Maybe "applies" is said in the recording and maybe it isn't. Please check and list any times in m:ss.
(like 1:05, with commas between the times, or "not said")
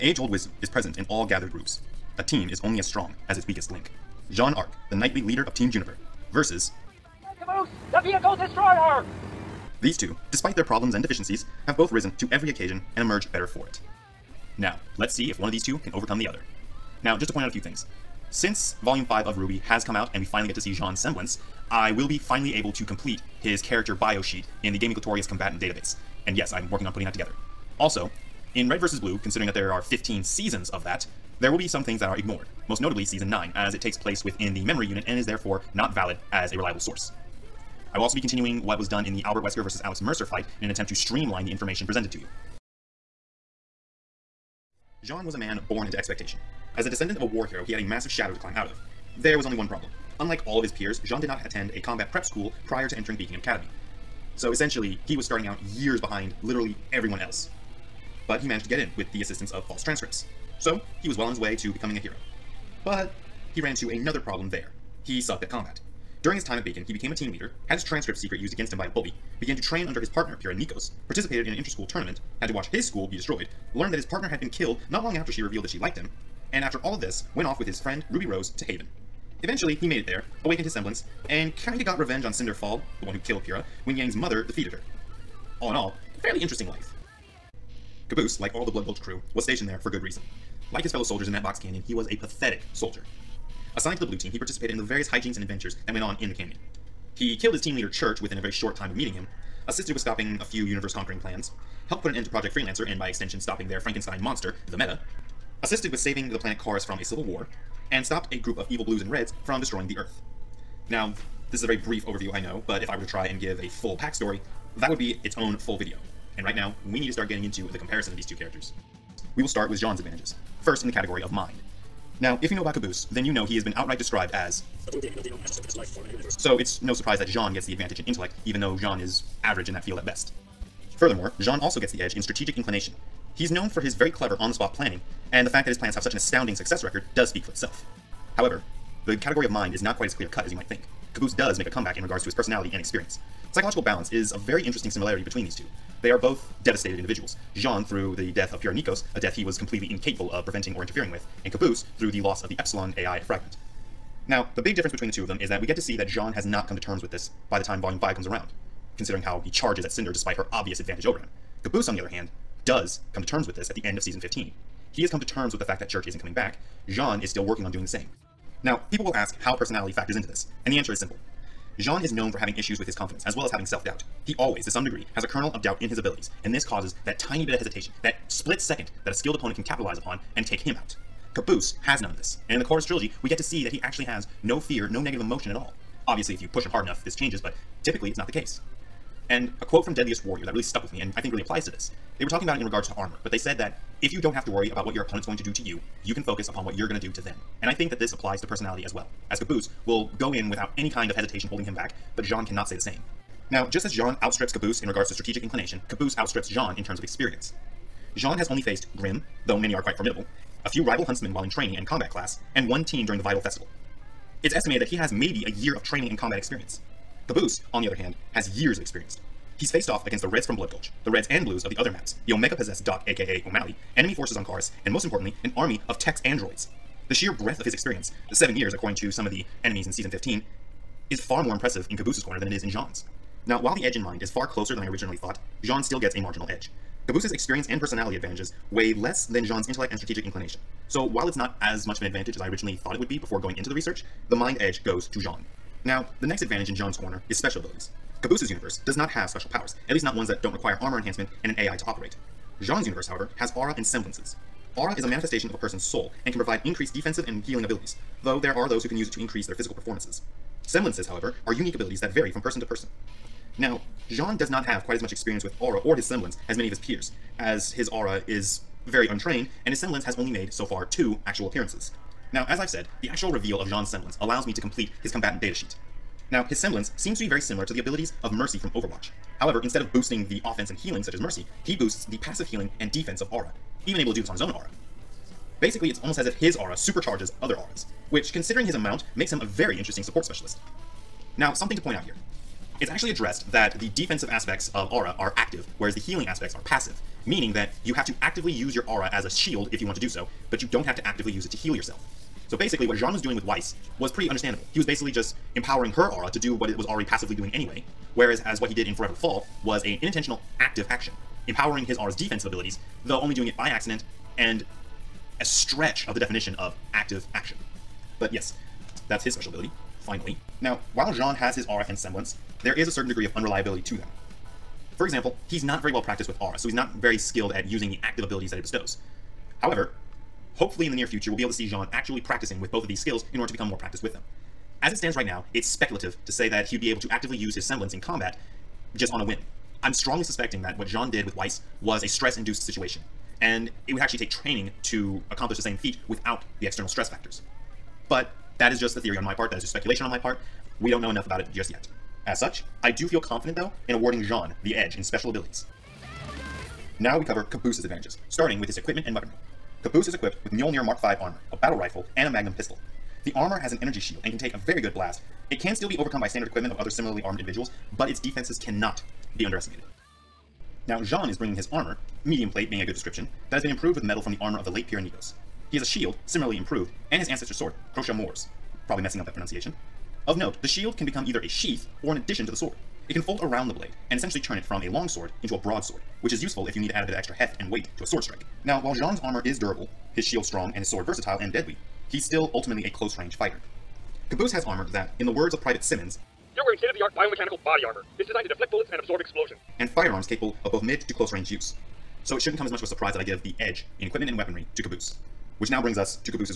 3:11, 3:18.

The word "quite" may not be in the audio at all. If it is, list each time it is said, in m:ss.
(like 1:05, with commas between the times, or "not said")
2:19, 3:29, 4:24.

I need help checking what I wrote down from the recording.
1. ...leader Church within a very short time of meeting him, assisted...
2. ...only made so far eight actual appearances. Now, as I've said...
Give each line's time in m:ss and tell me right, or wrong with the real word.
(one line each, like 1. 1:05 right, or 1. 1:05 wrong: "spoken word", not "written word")
1. 1:37 right
2. 4:30 wrong: "two", not "eight".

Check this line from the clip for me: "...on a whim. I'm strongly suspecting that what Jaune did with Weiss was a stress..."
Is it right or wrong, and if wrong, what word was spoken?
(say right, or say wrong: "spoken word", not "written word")
right.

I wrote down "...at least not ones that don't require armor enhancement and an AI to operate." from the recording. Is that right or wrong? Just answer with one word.
right.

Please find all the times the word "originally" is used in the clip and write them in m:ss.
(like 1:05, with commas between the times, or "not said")
3:54, 4:02.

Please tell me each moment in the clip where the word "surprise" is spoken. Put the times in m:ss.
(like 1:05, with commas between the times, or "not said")
2:06, 6:42.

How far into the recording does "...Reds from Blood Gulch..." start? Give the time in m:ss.
3:40.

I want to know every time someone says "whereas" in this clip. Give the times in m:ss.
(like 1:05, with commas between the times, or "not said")
4:55, 5:08.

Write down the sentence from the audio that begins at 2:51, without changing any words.
Jaune is known for having issues with his confidence, as well as having self-doubt.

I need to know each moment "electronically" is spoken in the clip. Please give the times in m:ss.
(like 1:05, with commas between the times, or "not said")
not said.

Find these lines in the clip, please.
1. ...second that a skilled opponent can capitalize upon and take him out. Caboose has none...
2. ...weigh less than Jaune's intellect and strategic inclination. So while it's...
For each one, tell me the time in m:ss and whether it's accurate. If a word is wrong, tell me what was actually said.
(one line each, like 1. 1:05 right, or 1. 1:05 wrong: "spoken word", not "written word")
1. 2:58 right
2. 3:58 right.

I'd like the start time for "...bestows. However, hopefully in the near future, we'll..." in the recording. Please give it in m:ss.
5:28.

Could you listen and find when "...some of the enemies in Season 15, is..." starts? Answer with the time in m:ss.
3:49.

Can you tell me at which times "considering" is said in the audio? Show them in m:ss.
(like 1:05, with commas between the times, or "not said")
0:29, 2:38, 4:48.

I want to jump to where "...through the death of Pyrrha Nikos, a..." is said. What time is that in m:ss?
2:27.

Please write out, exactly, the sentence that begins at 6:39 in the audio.
And firearms capable of both mid to close range use.